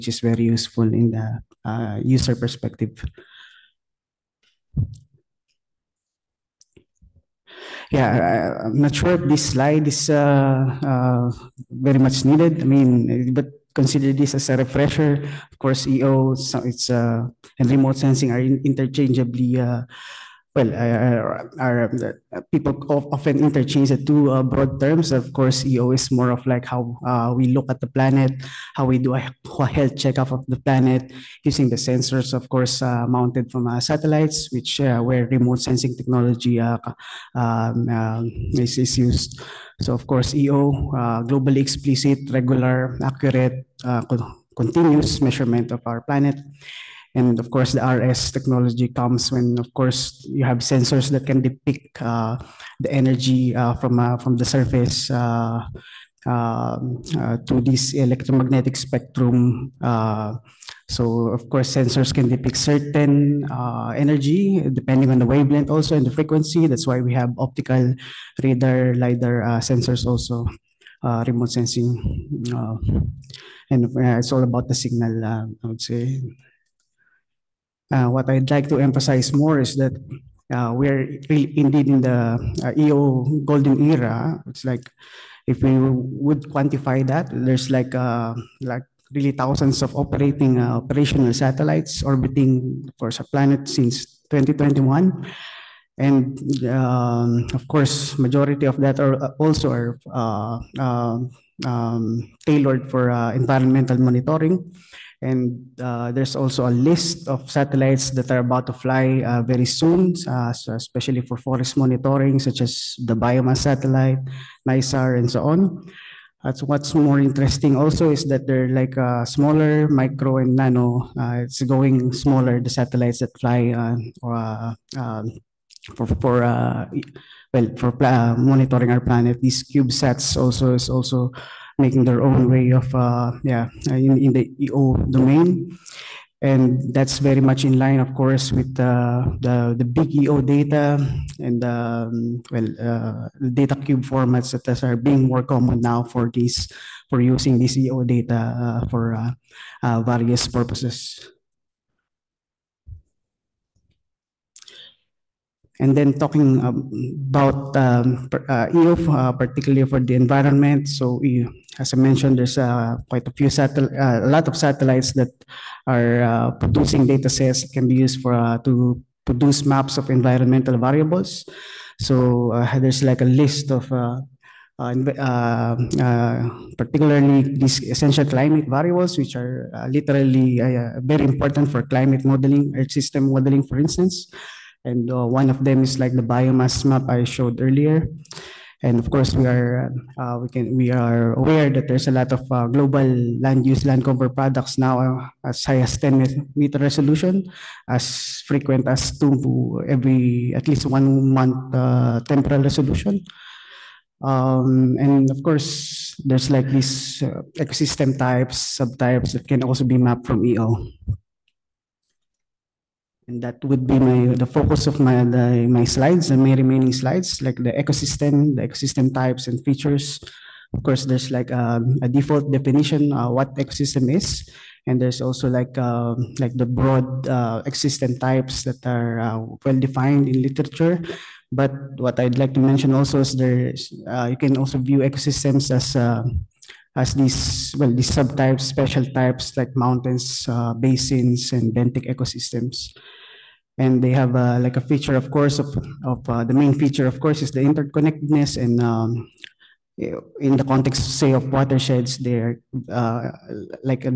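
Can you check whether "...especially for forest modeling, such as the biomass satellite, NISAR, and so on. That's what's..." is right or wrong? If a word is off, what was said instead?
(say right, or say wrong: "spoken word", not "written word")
wrong: "monitoring", not "modeling".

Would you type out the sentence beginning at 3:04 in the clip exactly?
And uh, one of them is like the biomass map I showed earlier.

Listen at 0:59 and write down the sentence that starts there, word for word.
Uh, so, of course, sensors can depict certain energy depending on the wavelength, also and the frequency.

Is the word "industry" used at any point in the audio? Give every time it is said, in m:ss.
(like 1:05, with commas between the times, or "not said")
not said.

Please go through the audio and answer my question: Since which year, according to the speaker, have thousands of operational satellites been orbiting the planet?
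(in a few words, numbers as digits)
2021.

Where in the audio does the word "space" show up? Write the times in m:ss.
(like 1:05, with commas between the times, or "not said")
not said.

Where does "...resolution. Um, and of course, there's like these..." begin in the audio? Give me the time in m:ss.
3:22.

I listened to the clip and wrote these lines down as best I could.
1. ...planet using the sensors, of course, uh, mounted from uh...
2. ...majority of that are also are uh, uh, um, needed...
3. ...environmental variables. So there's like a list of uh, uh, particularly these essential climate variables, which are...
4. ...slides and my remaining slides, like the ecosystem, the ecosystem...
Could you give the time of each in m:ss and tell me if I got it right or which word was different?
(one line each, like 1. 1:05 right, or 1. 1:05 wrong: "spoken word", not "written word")
1. 0:30 right
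2. 1:38 wrong: "tailored", not "needed"
3. 2:50 right
4. 3:35 right.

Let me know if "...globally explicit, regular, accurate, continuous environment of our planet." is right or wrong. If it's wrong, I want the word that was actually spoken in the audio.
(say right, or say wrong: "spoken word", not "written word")
wrong: "measurement", not "environment".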